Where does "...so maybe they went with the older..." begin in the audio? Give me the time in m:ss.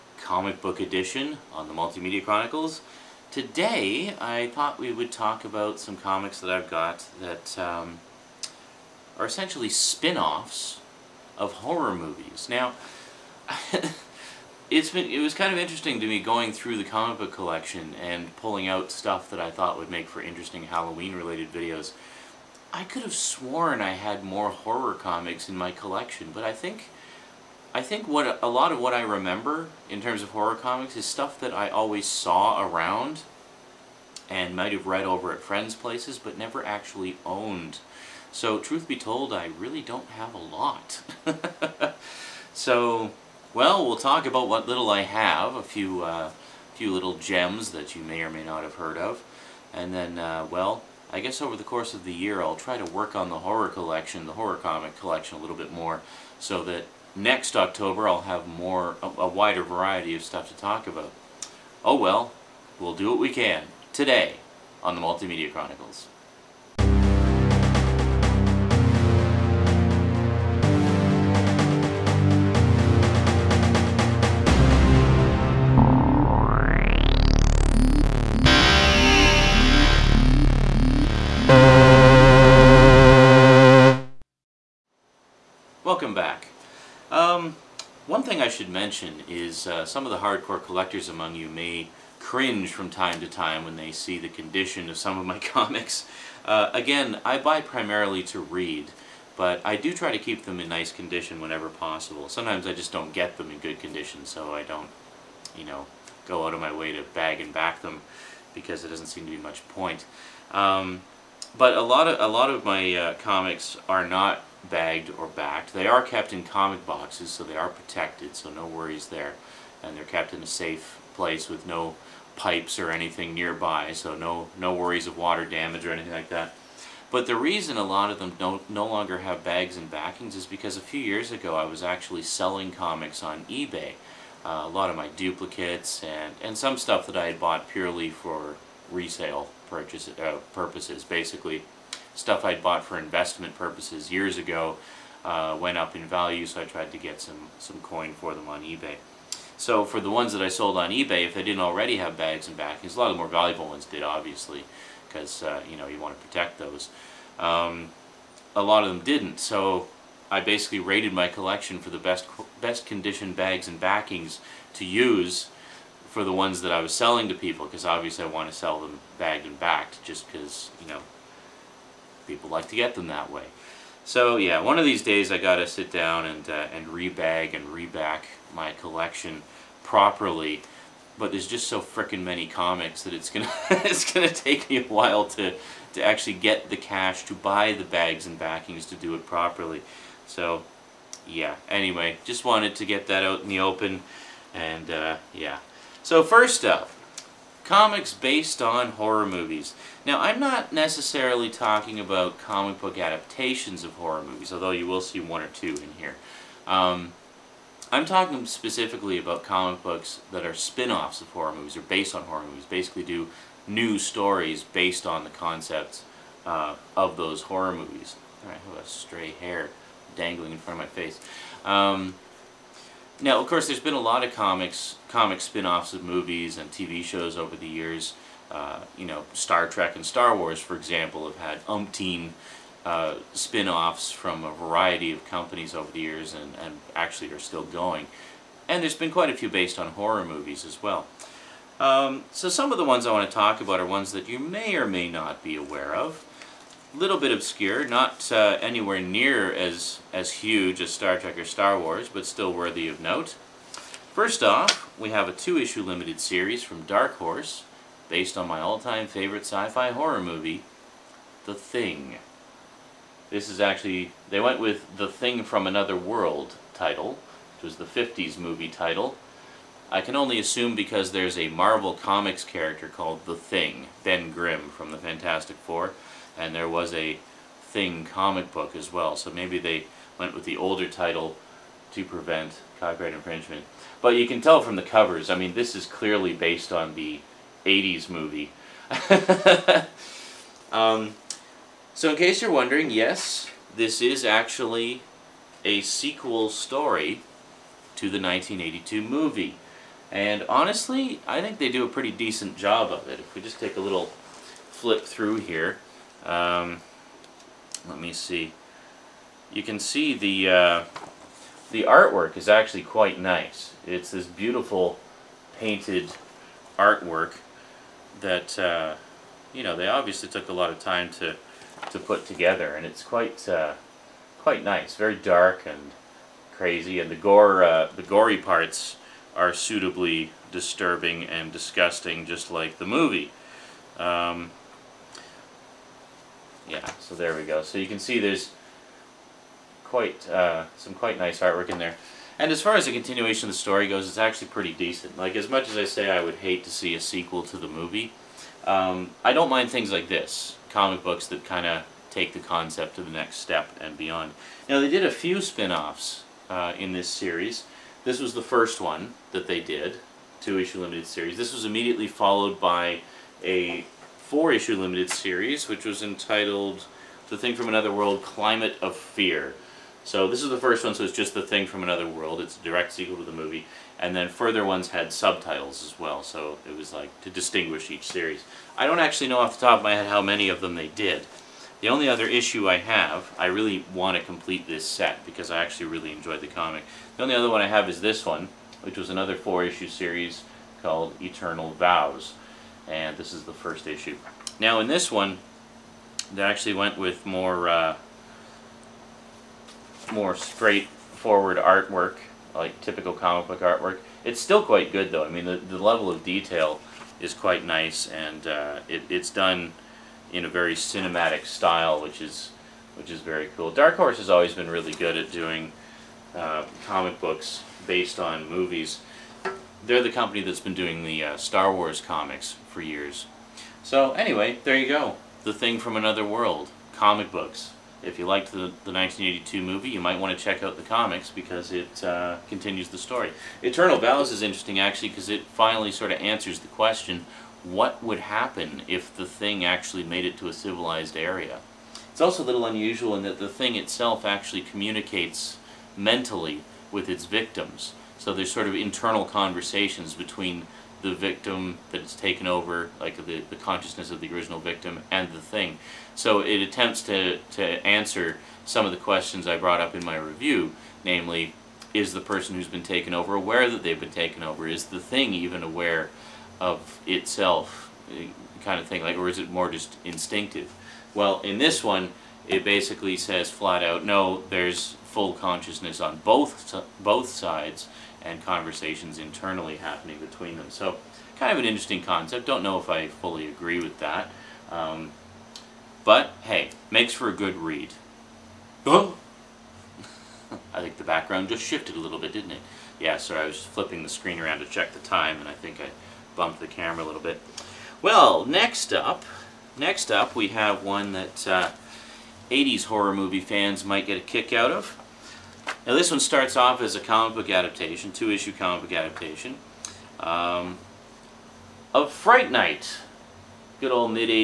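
4:39.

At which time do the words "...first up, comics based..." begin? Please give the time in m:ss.
3:16.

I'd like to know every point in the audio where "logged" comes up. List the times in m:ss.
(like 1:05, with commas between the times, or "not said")
not said.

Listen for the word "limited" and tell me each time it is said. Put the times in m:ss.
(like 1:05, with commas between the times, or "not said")
4:15, 6:00, 6:04.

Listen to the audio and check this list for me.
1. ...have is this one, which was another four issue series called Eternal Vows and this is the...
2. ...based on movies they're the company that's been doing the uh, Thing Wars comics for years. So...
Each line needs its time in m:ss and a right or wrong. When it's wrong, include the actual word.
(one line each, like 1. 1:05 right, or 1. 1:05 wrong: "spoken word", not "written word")
1. 6:27 right
2. 6:57 wrong: "Star", not "Thing".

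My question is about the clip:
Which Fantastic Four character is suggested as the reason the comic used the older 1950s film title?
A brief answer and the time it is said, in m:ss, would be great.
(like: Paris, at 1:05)
Ben Grimm, at 4:34.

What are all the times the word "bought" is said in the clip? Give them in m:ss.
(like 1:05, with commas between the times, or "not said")
2:17, 2:22.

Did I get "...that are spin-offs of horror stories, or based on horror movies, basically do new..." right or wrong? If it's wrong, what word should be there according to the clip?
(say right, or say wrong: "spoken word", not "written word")
wrong: "movies", not "stories".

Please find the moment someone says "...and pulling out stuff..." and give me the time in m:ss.
0:18.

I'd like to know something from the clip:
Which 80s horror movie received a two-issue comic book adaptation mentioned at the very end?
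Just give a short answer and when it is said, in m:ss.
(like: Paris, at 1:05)
Fright Night, at 8:32.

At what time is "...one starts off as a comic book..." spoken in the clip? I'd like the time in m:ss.
8:26.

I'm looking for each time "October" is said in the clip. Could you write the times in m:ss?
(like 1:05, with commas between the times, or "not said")
0:57.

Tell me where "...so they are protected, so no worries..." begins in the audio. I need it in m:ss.
1:57.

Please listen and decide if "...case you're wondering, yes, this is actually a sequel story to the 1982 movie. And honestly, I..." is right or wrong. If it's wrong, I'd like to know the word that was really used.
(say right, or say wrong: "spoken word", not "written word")
right.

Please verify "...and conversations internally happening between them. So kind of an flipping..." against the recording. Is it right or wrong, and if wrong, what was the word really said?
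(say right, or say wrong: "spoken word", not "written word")
wrong: "interesting", not "flipping".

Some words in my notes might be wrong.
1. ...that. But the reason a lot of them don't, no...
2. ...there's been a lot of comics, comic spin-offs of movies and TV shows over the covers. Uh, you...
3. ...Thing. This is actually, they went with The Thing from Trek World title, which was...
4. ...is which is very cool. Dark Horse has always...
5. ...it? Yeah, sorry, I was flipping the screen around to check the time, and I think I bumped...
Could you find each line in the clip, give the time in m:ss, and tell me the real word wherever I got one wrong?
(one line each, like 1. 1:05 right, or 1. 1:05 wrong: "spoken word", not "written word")
1. 2:06 right
2. 3:43 wrong: "years", not "covers"
3. 4:21 wrong: "Another", not "Trek"
4. 6:52 right
5. 8:12 right.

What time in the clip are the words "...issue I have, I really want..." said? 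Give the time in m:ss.
6:22.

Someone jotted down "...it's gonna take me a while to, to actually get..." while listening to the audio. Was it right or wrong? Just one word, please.
right.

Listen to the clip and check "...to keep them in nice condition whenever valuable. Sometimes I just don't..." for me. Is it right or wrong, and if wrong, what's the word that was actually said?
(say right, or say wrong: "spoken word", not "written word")
wrong: "possible", not "valuable".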